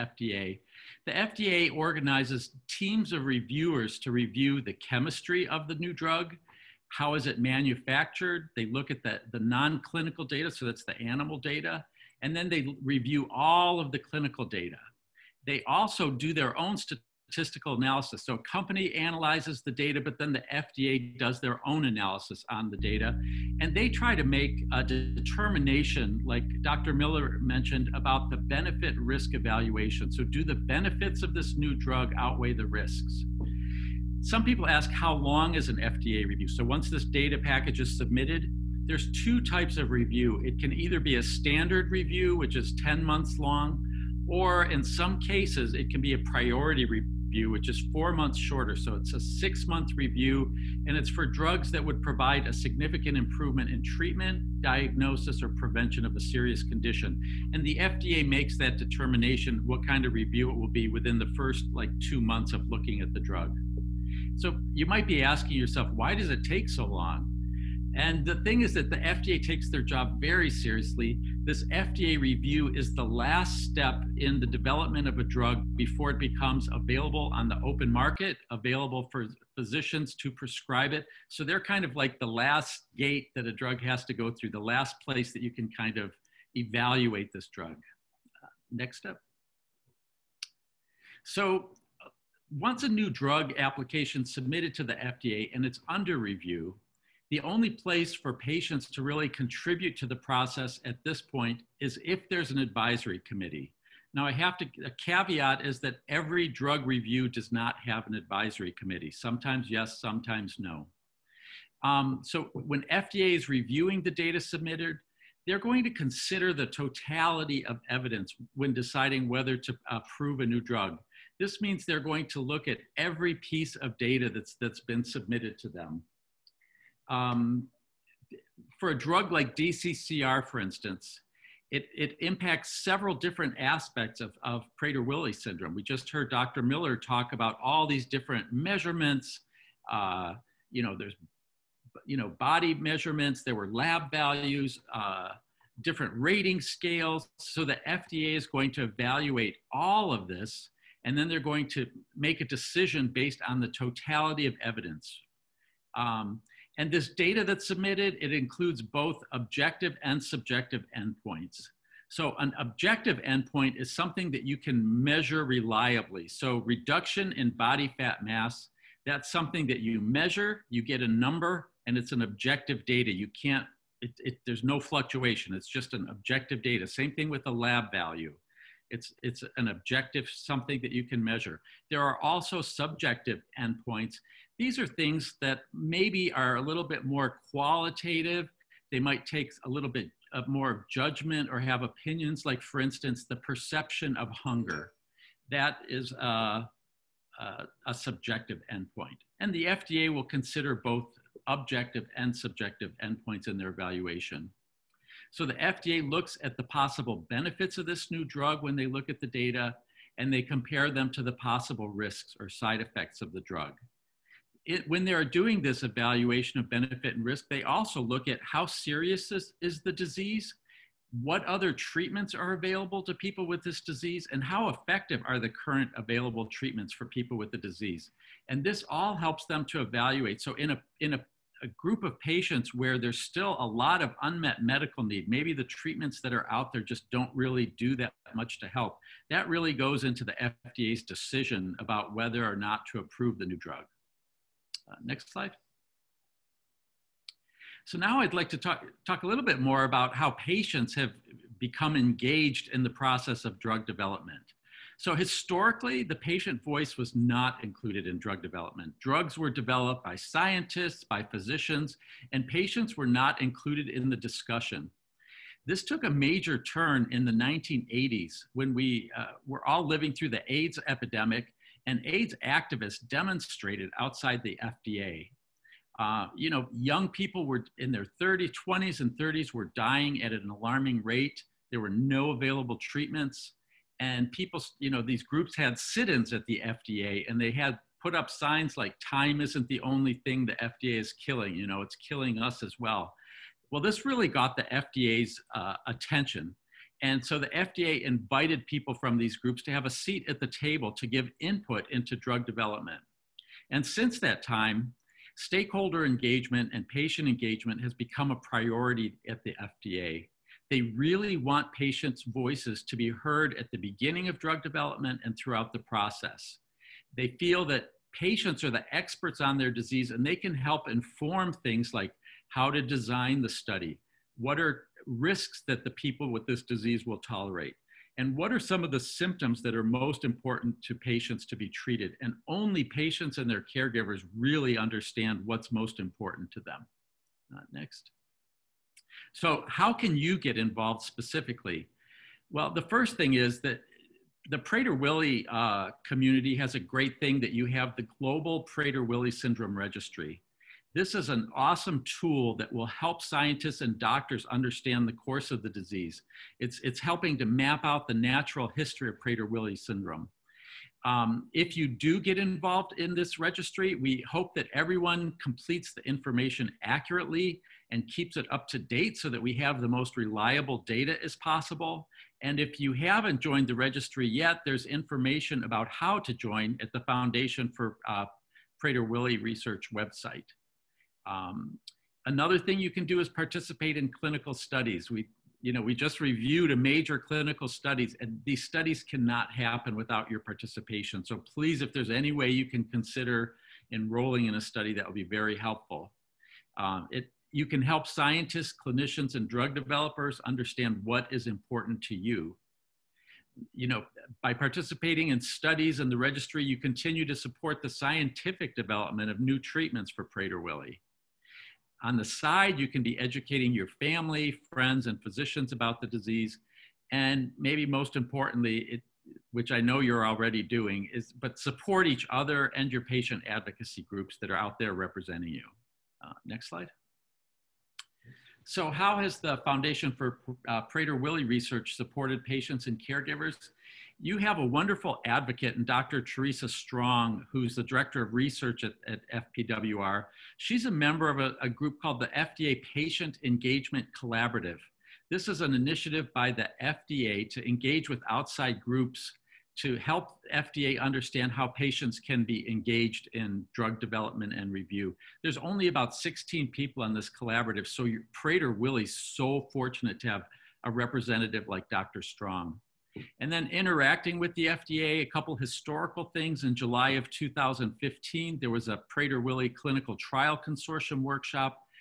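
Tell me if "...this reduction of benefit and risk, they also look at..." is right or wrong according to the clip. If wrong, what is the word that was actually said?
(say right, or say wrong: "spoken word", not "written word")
wrong: "evaluation", not "reduction".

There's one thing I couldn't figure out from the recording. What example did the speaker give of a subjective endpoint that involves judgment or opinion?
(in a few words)
Perception of hunger.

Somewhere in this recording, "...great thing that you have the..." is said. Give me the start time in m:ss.
5:46.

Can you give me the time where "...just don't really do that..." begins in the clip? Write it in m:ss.
3:56.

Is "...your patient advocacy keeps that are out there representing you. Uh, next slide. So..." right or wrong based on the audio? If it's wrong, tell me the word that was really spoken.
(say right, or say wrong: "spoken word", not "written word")
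wrong: "groups", not "keeps".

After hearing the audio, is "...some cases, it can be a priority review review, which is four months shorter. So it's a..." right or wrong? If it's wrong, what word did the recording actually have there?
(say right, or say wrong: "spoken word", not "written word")
right.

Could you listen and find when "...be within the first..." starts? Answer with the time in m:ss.
1:00.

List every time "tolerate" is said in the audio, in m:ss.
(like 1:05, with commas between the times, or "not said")
5:27.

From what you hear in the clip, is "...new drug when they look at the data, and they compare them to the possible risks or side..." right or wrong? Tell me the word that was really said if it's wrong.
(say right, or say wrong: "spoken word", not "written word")
right.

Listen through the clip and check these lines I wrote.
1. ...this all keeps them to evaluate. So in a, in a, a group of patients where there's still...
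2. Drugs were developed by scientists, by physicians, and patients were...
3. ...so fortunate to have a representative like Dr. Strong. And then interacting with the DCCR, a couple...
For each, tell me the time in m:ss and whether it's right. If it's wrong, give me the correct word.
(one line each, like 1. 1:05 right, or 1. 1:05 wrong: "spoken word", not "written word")
1. 3:48 wrong: "helps", not "keeps"
2. 4:19 right
3. 7:39 wrong: "FDA", not "DCCR".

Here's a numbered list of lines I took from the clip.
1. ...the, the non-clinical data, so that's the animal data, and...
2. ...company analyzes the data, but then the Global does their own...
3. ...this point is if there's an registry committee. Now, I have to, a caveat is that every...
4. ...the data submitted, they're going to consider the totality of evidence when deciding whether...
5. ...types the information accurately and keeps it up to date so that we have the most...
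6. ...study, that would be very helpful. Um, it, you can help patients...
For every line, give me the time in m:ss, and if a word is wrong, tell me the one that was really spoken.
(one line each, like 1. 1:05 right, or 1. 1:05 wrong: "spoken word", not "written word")
1. 0:09 right
2. 0:18 wrong: "FDA", not "Global"
3. 1:41 wrong: "advisory", not "registry"
4. 1:54 right
5. 6:05 wrong: "completes", not "types"
6. 6:34 wrong: "scientists", not "patients".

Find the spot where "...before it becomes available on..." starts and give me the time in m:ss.
1:15.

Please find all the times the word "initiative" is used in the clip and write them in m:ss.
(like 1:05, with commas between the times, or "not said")
7:25.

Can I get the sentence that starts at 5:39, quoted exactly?
So, how can you get involved specifically?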